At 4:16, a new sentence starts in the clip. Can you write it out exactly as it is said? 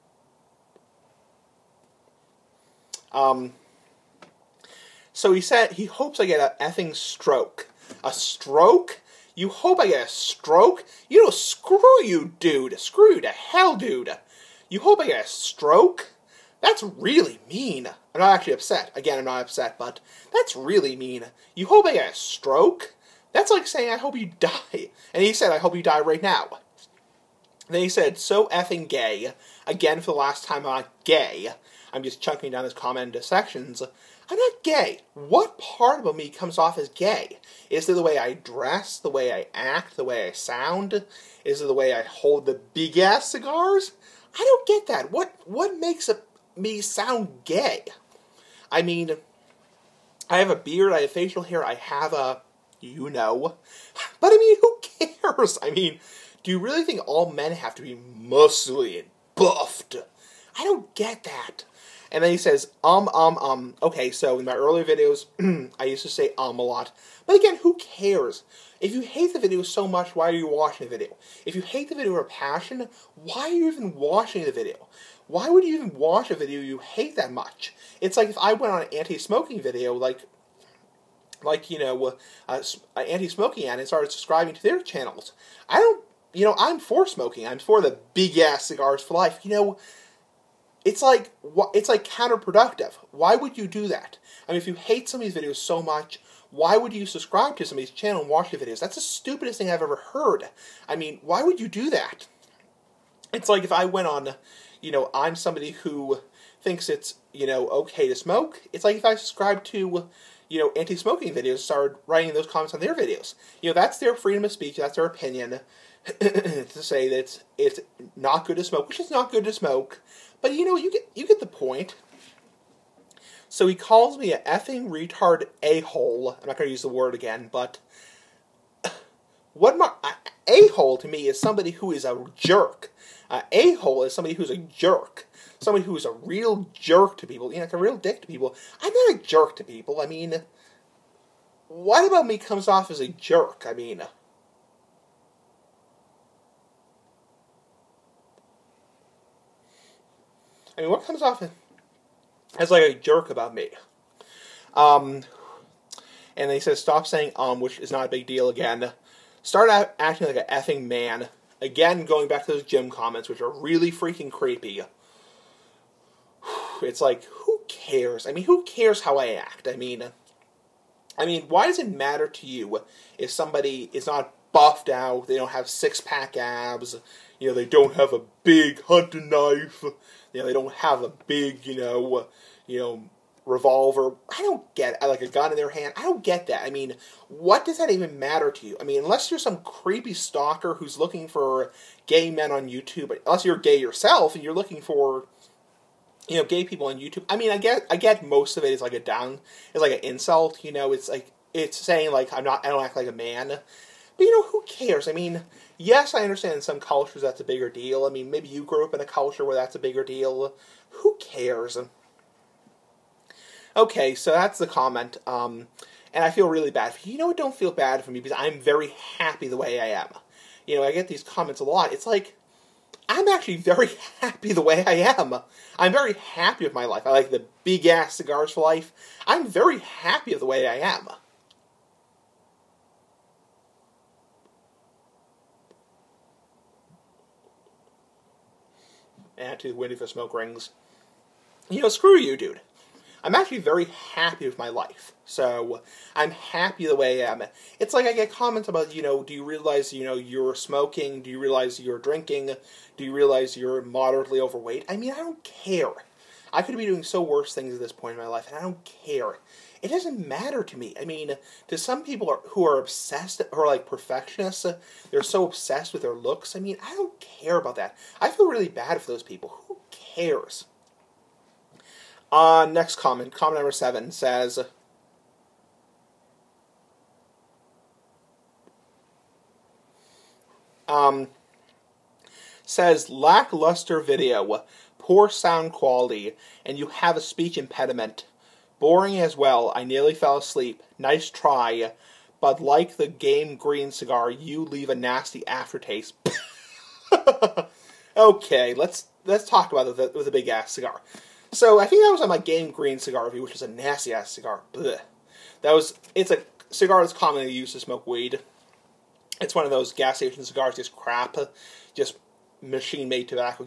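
I could be doing so worse things at this point in my life, and I don't care.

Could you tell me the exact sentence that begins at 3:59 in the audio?
and eh, to Windy for Smoke Rings.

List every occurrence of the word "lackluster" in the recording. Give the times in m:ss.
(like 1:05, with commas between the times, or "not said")
4:43.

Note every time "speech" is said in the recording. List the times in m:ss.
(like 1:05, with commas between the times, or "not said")
1:54, 4:47.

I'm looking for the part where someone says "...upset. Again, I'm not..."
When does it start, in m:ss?
0:18.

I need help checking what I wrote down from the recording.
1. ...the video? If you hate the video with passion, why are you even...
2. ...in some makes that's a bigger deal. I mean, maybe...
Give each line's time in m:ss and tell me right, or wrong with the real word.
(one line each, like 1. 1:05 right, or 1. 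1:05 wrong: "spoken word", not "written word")
1. 1:10 right
2. 3:26 wrong: "cultures", not "makes".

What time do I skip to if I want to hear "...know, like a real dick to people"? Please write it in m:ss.
2:17.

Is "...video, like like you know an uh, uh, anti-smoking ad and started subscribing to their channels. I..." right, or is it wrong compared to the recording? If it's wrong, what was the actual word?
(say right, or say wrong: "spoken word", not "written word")
right.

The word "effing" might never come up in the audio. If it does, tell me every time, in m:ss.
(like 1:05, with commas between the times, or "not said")
0:06, 0:28, 2:04, 2:40.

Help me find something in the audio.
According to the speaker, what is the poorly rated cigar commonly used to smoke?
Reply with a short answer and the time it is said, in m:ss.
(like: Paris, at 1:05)
Weed, at 5:08.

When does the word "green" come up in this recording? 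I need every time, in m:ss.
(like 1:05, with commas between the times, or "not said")
4:53, 5:02.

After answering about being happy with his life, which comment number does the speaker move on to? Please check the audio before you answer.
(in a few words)
7.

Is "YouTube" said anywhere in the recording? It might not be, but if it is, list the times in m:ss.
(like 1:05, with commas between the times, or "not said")
3:12, 3:16.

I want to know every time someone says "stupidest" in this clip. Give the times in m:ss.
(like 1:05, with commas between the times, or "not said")
1:39.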